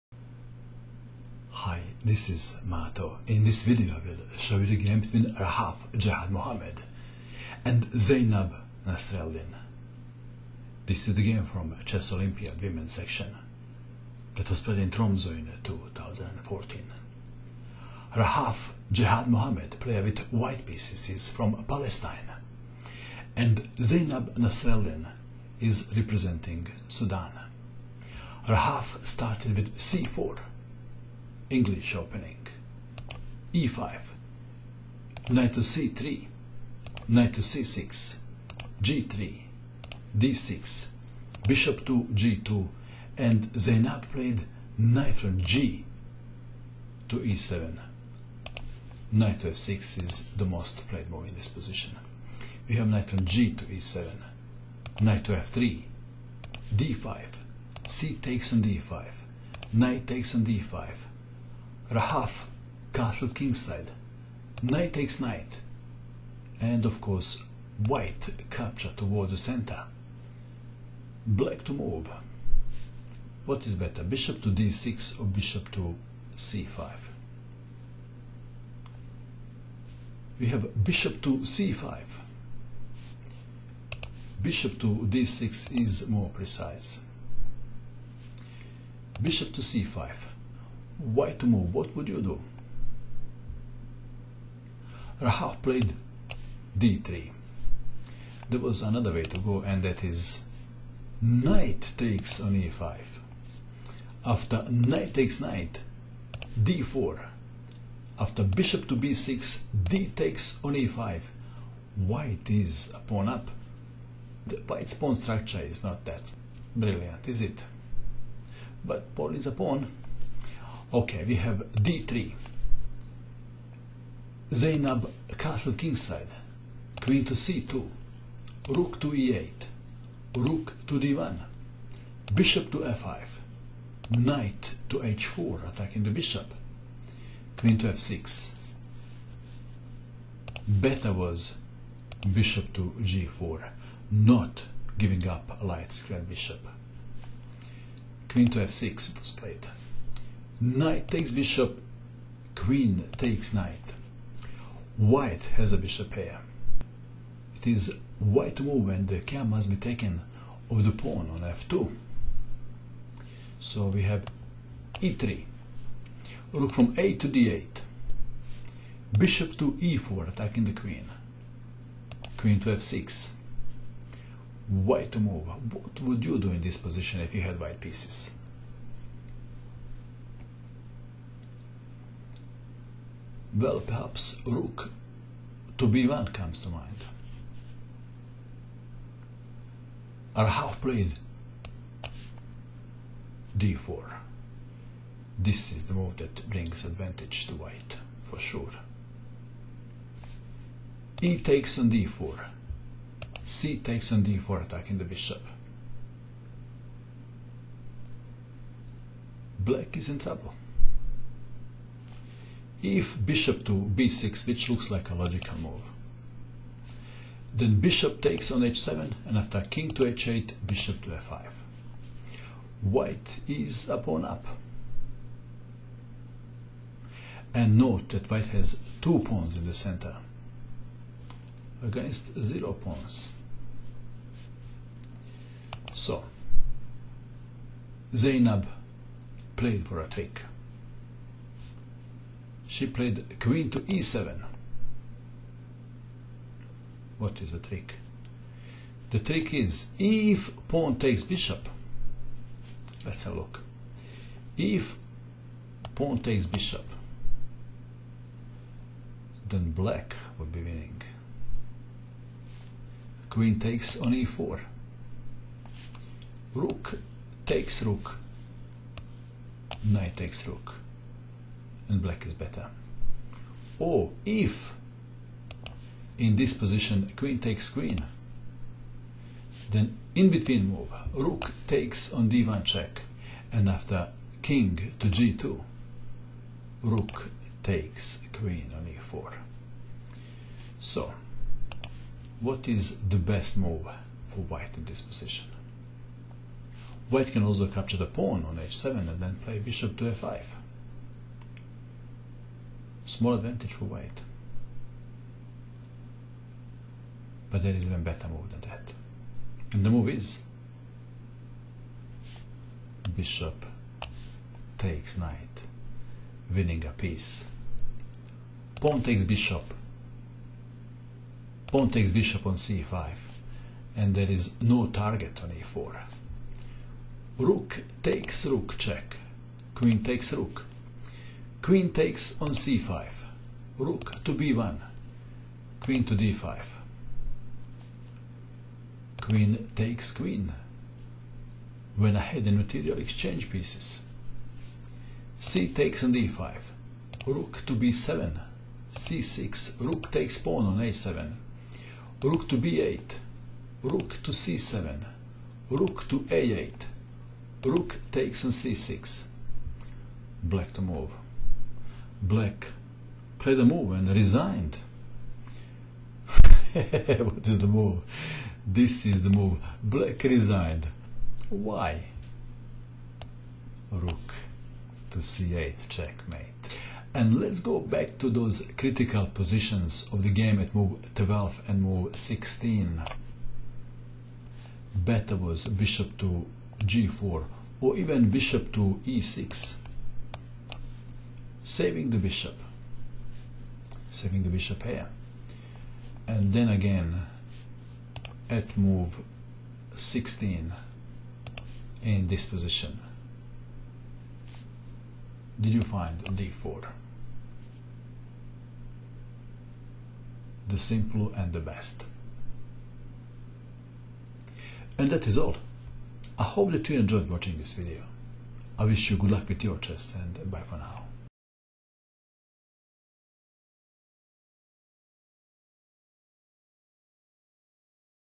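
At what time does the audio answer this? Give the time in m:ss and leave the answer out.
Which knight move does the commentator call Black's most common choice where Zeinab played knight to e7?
0:49.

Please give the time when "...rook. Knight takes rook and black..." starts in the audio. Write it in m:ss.
4:27.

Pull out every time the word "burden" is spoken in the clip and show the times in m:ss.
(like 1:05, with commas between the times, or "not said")
not said.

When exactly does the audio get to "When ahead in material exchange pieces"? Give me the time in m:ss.
5:41.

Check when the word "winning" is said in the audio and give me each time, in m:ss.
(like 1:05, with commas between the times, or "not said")
4:20, 5:16.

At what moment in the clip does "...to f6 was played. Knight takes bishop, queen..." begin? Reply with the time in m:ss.
2:28.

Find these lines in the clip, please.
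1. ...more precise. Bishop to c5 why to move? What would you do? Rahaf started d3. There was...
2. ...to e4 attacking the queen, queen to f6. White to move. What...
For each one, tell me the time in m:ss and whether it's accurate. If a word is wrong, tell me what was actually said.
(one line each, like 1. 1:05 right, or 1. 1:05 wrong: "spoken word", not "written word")
1. 1:26 wrong: "played", not "started"
2. 2:49 right.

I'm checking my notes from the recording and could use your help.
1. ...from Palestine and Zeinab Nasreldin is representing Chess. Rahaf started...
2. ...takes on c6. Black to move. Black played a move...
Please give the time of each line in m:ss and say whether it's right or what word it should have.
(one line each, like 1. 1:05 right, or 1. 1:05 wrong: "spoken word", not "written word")
1. 0:21 wrong: "Sudan", not "Chess"
2. 5:58 right.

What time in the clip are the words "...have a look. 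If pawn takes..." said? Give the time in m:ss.
4:13.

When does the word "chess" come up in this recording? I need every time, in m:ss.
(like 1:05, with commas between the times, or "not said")
0:11, 6:59.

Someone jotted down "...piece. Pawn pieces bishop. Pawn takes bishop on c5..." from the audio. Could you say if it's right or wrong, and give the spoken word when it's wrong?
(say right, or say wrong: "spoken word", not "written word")
wrong: "takes", not "pieces".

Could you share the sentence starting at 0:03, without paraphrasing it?
In this video I will show you the game between Rahaf Jehad Mohamed and Zeinab Nasreldin.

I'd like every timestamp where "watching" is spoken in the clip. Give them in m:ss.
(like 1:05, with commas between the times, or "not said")
6:57.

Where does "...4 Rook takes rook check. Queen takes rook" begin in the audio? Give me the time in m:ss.
5:25.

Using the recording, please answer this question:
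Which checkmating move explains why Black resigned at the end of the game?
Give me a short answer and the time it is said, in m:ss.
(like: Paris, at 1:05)
Rook to c8, at 6:13.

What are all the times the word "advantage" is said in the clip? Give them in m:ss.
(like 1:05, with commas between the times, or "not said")
3:16, 5:03.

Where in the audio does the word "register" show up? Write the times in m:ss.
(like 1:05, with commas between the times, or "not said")
not said.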